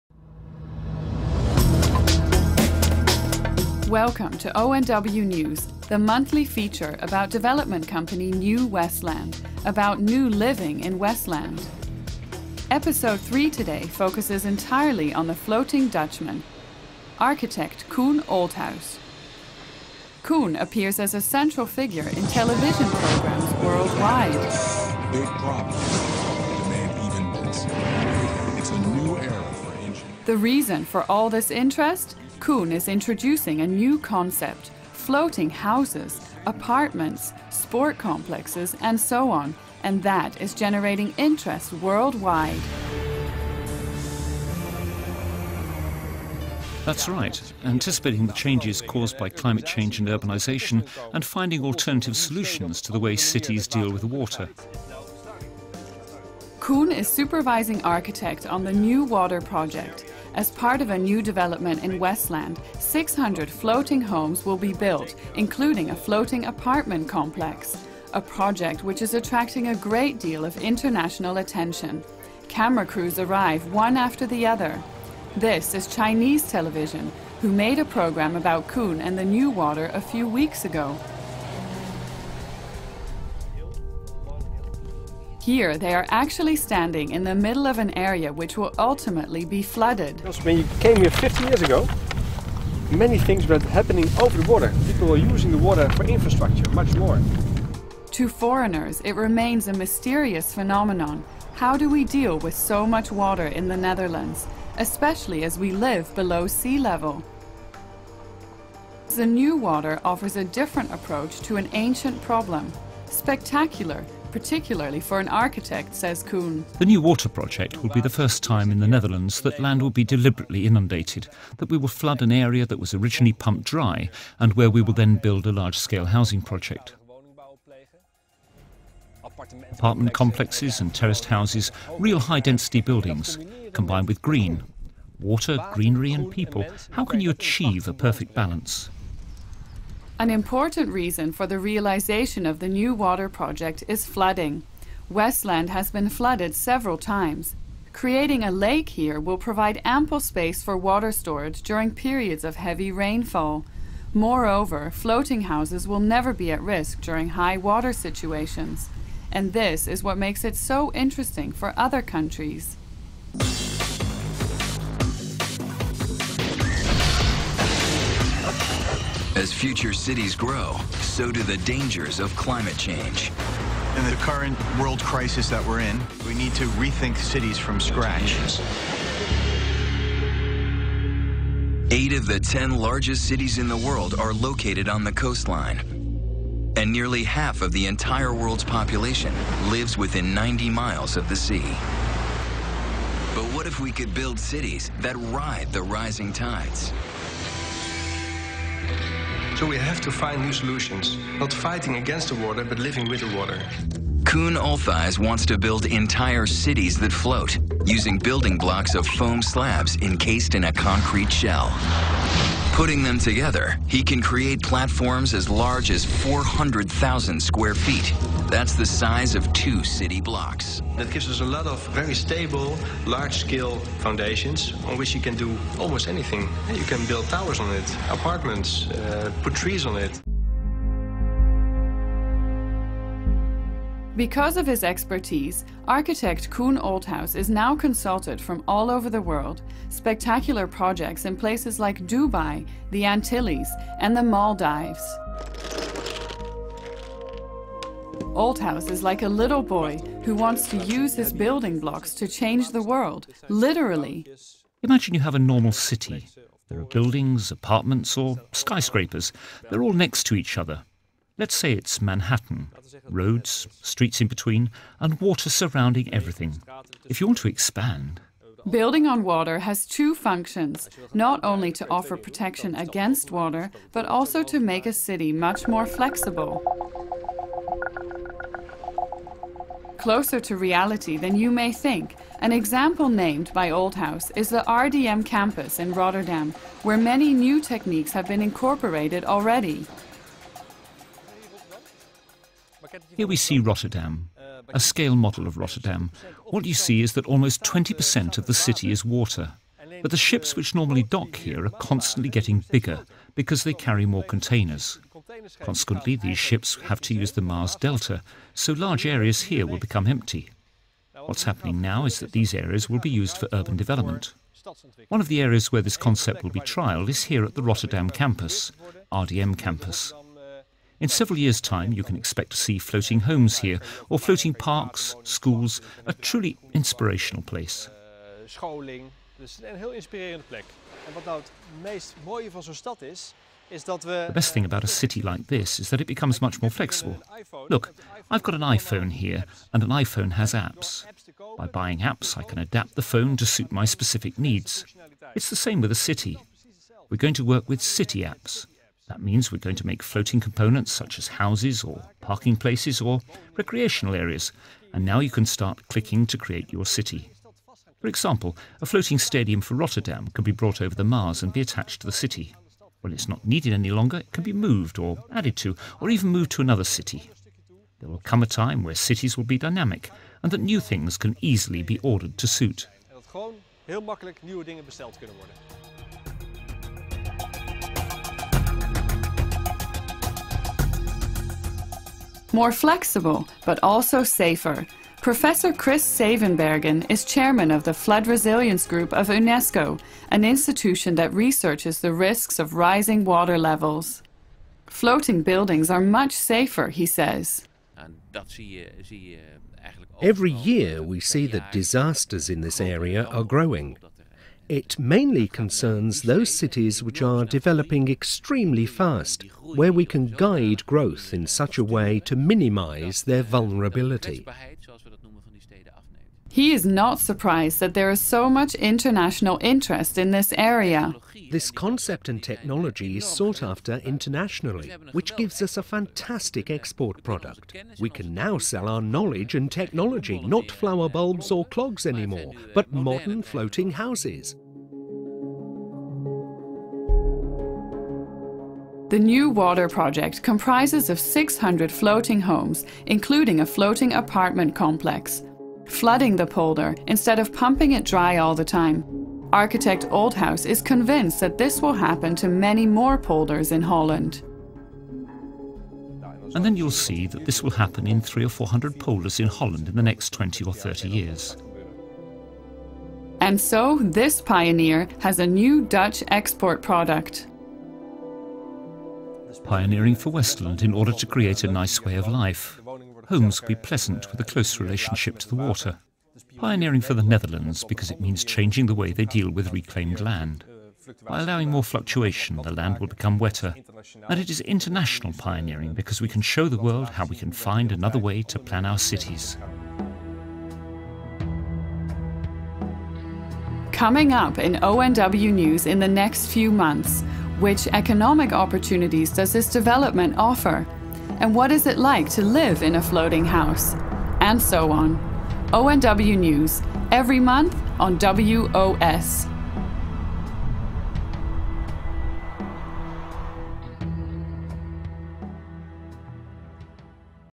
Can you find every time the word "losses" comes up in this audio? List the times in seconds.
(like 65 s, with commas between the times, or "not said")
not said.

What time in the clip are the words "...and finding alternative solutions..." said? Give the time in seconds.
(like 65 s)
51 s.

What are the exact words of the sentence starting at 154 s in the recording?
Moreover, floating houses will never be at risk during high water situations.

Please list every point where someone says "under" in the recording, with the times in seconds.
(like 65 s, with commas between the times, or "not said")
not said.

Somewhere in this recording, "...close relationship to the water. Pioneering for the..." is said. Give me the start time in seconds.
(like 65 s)
474 s.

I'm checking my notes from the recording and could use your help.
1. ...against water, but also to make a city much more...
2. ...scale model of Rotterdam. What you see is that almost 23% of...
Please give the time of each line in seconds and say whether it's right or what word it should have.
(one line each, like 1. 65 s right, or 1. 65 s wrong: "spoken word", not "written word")
1. 272 s right
2. 294 s wrong: "20", not "23".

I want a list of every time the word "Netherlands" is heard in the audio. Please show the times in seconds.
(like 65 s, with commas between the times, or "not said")
103 s, 118 s, 477 s.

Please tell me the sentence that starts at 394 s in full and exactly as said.
Floating buildings are much safer, he says.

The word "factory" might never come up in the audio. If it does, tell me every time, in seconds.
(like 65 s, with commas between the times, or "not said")
not said.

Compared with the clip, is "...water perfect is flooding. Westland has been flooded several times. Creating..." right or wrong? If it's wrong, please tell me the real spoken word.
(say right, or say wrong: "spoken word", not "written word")
wrong: "project", not "perfect".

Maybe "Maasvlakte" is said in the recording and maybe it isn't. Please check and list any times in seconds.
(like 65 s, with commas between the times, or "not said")
307 s.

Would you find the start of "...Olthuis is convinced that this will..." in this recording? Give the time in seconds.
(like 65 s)
450 s.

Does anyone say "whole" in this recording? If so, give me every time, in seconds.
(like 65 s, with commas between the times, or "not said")
not said.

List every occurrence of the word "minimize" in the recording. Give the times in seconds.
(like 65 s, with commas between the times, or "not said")
412 s.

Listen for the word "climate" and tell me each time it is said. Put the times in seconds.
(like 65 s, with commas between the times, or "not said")
49 s, 172 s.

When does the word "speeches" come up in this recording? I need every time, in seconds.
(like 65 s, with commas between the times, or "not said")
not said.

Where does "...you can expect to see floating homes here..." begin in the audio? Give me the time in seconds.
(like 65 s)
321 s.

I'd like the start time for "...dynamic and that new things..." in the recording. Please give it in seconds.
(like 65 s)
369 s.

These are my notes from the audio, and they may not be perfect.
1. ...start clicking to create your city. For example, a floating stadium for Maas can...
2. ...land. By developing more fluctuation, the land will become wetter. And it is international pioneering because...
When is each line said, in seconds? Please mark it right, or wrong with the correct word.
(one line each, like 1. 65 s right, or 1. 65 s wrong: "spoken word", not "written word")
1. 355 s wrong: "Rotterdam", not "Maas"
2. 480 s wrong: "allowing", not "developing".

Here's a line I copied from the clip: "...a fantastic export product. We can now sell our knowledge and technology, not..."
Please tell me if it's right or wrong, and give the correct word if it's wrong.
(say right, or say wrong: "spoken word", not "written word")
right.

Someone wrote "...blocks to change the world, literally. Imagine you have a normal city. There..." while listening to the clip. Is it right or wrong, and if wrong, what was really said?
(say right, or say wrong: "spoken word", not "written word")
right.